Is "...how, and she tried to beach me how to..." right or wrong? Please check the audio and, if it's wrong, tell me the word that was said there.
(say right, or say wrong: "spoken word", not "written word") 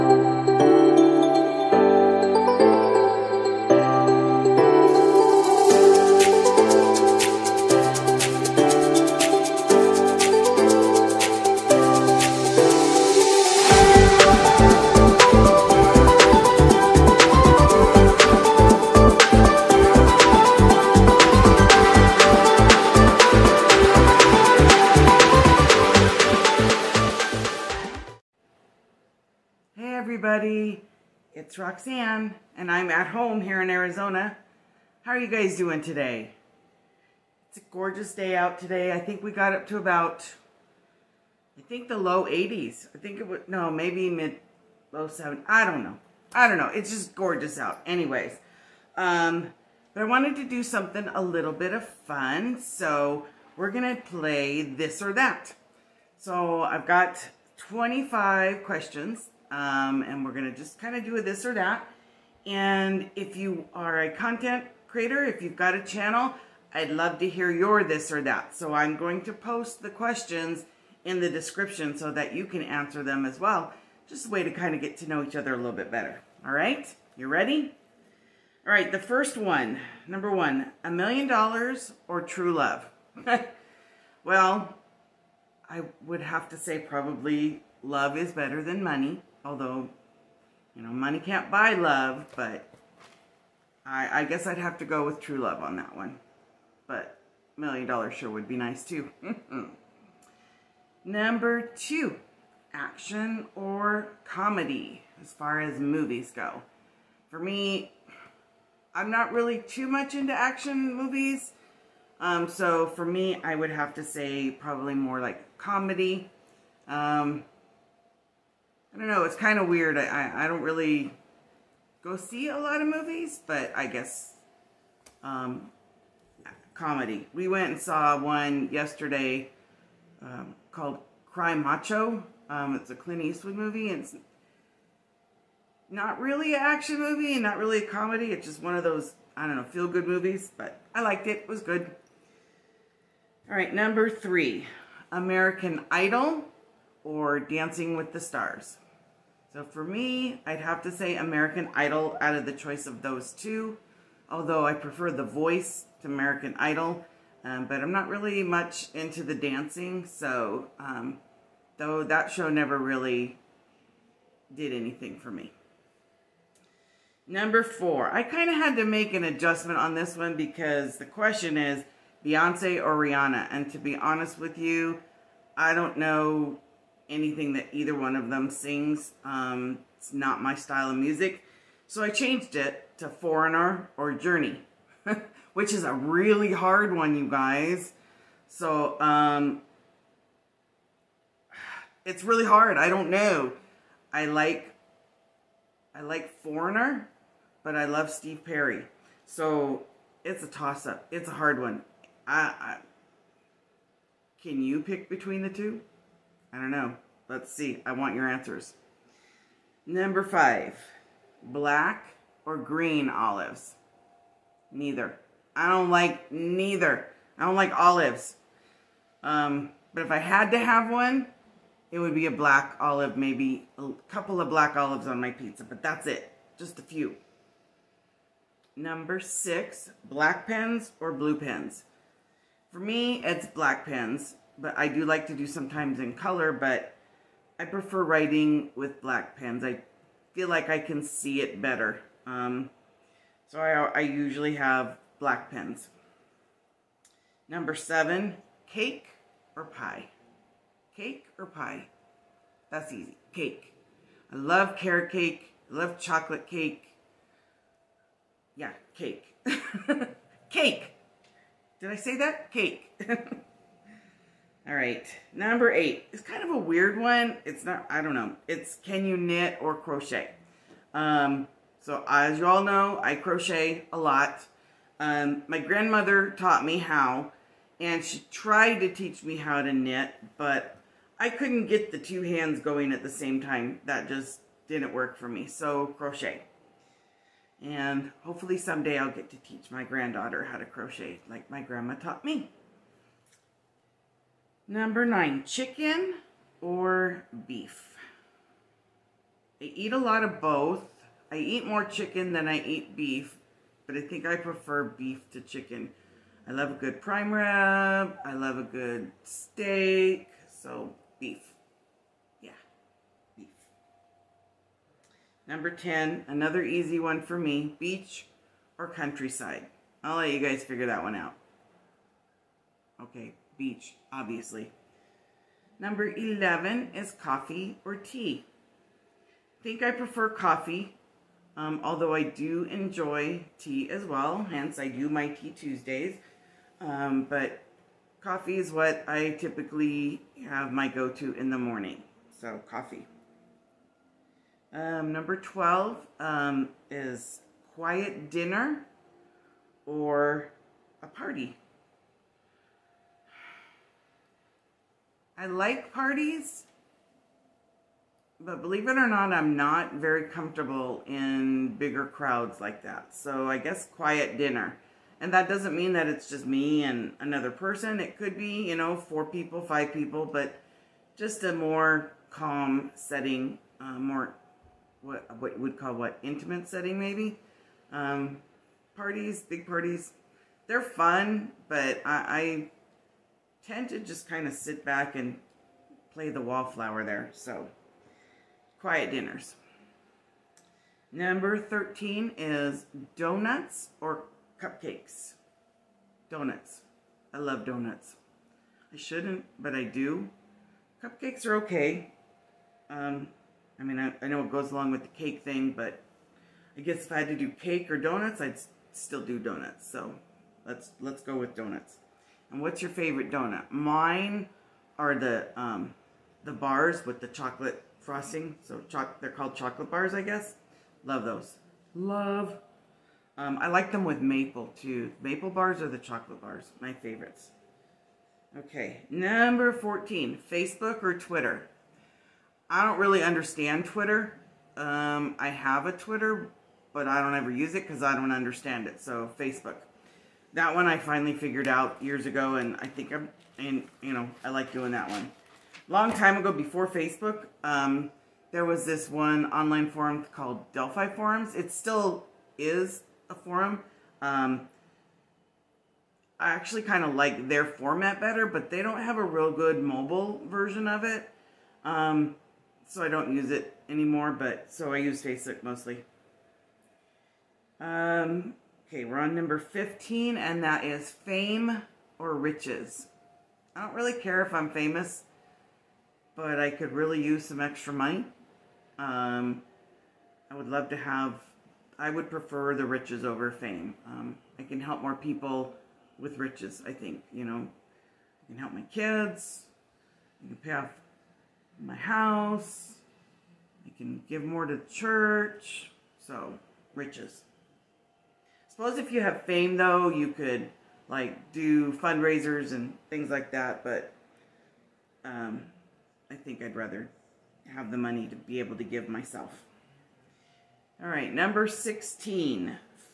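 wrong: "teach", not "beach".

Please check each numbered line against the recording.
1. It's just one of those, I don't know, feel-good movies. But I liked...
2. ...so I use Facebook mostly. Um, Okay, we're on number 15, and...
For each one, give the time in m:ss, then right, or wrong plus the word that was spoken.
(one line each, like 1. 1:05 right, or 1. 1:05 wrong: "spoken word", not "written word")
1. 2:18 right
2. 7:44 right.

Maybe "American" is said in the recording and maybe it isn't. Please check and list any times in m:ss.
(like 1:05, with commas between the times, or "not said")
2:25, 2:31, 2:36.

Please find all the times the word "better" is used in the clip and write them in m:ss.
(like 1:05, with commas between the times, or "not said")
1:15, 1:28, 4:01, 7:38.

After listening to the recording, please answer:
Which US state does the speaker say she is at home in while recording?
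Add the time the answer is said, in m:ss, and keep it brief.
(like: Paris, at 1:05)
Arizona, at 0:33.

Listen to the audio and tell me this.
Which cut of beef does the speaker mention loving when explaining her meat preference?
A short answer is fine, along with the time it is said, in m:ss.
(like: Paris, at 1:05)
Prime rib, at 5:07.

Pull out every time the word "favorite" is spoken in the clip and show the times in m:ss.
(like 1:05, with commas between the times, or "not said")
6:52, 7:06.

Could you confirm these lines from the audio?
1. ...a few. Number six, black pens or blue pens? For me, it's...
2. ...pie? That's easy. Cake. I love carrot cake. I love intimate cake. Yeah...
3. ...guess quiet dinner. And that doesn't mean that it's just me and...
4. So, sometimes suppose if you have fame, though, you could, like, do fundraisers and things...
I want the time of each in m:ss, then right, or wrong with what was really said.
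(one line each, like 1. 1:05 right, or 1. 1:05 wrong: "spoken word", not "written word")
1. 3:46 right
2. 4:11 wrong: "chocolate", not "intimate"
3. 6:03 right
4. 8:16 wrong: "riches", not "sometimes".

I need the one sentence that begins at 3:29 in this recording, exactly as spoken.
Number five, black or green olives?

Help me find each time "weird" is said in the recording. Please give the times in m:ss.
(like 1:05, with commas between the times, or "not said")
1:59, 4:26.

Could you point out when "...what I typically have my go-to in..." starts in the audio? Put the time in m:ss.
5:38.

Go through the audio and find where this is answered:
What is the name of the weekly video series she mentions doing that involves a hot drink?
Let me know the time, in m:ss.
5:35.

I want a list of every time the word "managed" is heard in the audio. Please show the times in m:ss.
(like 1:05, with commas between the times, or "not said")
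not said.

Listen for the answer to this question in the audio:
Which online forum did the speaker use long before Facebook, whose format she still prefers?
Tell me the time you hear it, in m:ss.
7:30.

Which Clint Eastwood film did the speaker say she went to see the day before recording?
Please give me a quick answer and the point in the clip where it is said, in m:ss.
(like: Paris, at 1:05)
Cry Macho, at 2:11.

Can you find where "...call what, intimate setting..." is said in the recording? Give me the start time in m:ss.
6:15.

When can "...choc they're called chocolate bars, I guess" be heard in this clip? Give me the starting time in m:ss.
6:58.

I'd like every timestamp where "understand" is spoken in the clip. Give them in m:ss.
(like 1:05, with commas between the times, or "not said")
7:13, 7:18.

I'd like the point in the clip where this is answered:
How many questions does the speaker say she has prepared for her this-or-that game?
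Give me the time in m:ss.
0:57.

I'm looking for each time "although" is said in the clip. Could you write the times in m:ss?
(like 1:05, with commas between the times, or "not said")
1:29, 2:34, 5:31.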